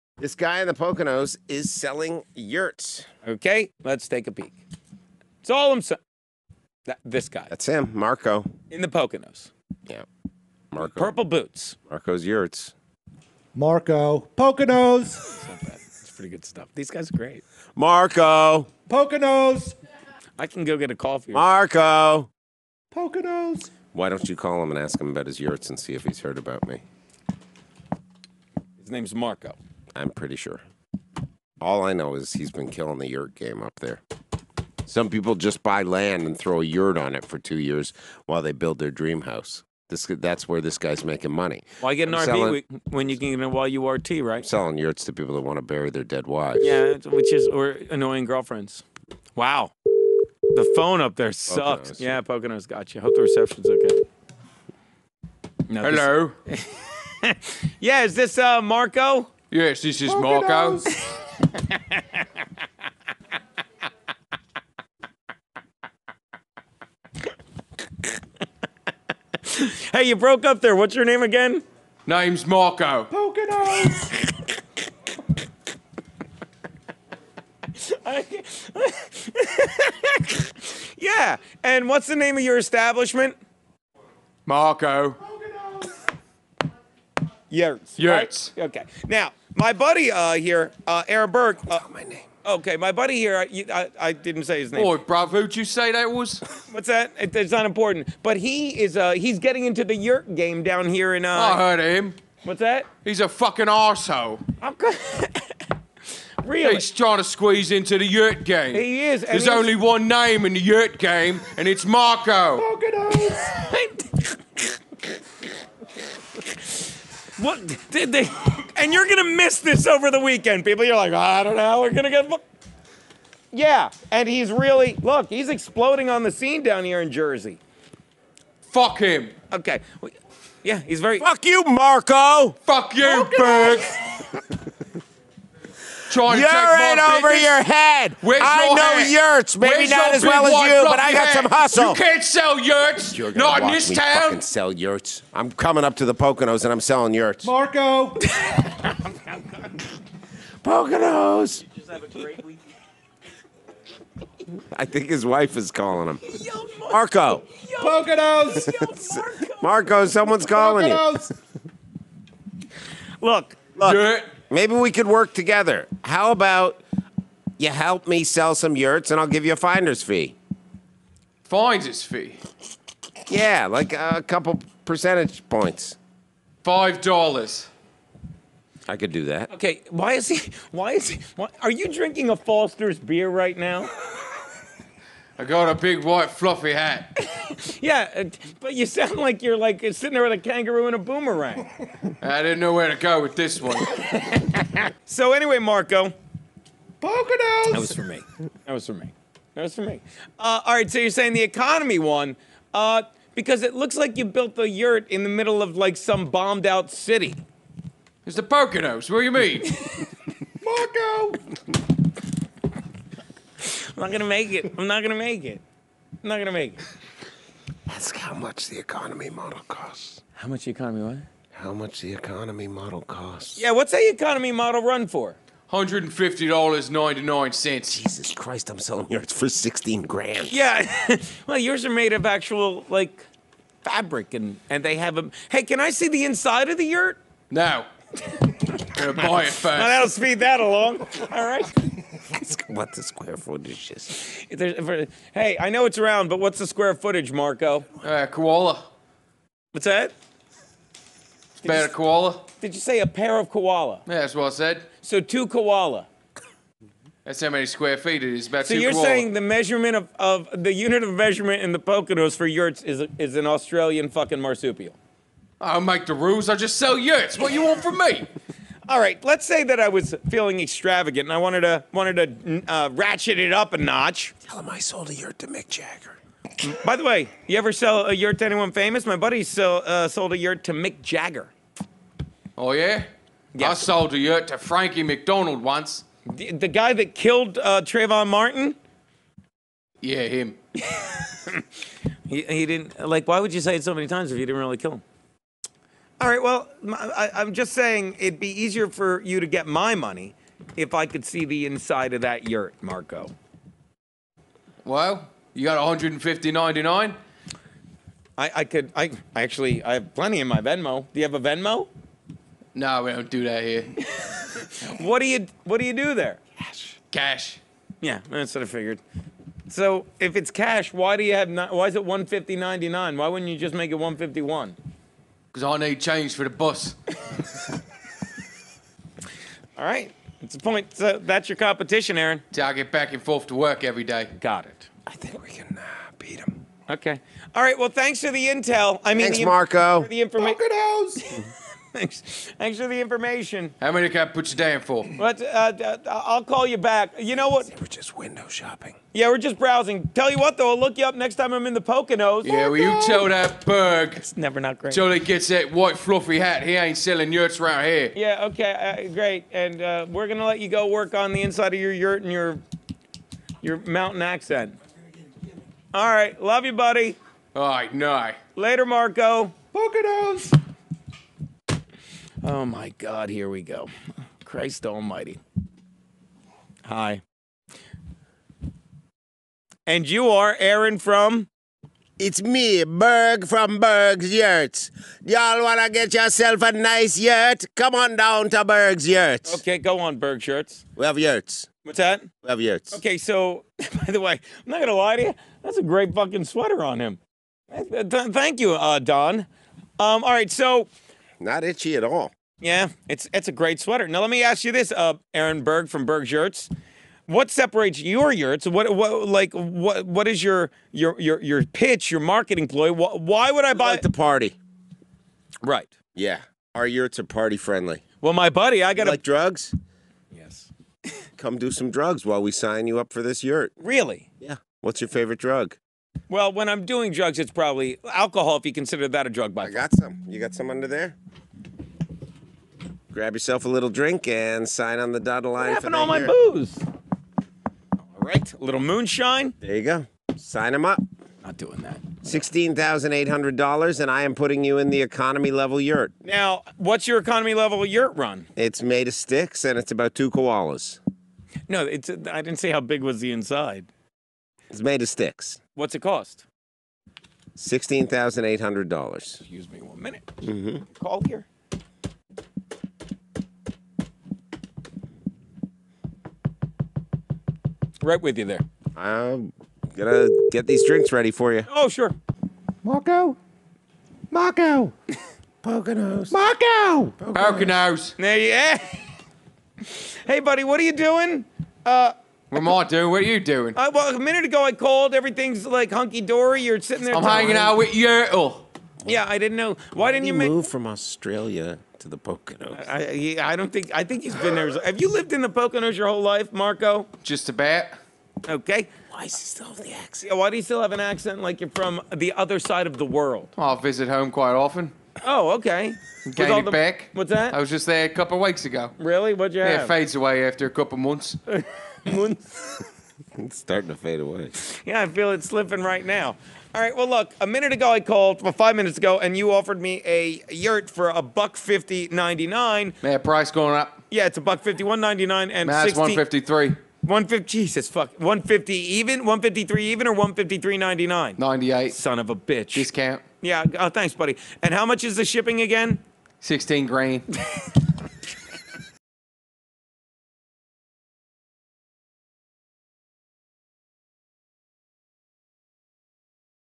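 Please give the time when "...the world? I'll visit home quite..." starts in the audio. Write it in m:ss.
8:22.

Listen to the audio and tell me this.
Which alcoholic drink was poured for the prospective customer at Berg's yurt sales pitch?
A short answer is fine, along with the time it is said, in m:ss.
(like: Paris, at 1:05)
Moonshine, at 7:18.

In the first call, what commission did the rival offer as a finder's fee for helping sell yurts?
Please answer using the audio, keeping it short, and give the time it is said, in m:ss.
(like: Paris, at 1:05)
5 dollars, at 2:56.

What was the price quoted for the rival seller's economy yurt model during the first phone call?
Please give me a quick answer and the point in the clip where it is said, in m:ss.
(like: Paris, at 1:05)
$150.99, at 3:45.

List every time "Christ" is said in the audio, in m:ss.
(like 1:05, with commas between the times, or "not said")
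3:48, 6:14.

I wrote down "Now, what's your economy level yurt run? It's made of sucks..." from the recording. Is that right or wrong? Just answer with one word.
wrong.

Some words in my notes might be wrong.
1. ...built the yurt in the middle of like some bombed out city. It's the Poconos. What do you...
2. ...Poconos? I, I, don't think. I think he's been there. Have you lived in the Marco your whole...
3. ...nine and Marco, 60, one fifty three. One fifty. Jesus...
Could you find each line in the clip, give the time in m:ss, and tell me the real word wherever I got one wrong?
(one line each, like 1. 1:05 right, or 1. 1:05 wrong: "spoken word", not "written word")
1. 3:24 right
2. 8:12 wrong: "Poconos", not "Marco"
3. 8:45 wrong: "Man", not "Marco".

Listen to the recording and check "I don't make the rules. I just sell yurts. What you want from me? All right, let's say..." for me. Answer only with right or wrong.
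right.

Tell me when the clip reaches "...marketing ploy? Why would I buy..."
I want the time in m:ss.
6:52.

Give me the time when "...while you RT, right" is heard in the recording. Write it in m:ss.
0:43.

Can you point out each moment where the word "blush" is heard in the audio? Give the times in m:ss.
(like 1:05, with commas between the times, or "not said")
not said.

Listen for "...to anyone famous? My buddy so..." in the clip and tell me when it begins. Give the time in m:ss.
4:38.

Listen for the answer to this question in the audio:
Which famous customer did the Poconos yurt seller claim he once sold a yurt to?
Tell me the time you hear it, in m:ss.
4:44.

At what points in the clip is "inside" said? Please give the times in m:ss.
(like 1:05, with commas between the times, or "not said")
3:56, 5:01, 6:01, 7:33.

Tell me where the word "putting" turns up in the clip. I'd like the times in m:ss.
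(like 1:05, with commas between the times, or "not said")
7:24.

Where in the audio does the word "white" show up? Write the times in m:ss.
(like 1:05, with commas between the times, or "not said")
3:06, 5:55.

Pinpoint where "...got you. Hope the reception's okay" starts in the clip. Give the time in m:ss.
0:52.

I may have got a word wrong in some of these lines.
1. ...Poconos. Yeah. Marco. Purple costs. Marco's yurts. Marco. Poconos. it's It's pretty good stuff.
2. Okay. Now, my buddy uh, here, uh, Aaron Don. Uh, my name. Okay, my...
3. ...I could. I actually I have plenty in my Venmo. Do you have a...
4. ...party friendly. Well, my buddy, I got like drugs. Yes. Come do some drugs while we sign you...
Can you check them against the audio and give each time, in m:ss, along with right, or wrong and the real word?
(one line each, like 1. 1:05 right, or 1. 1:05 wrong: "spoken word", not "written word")
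1. 0:08 wrong: "boots", not "costs"
2. 1:28 wrong: "Berg", not "Don"
3. 5:08 right
4. 6:57 right.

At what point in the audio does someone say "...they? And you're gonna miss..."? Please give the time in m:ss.
1:58.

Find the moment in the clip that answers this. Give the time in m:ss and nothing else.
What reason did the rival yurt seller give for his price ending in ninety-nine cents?
5:25.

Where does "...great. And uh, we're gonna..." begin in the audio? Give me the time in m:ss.
5:59.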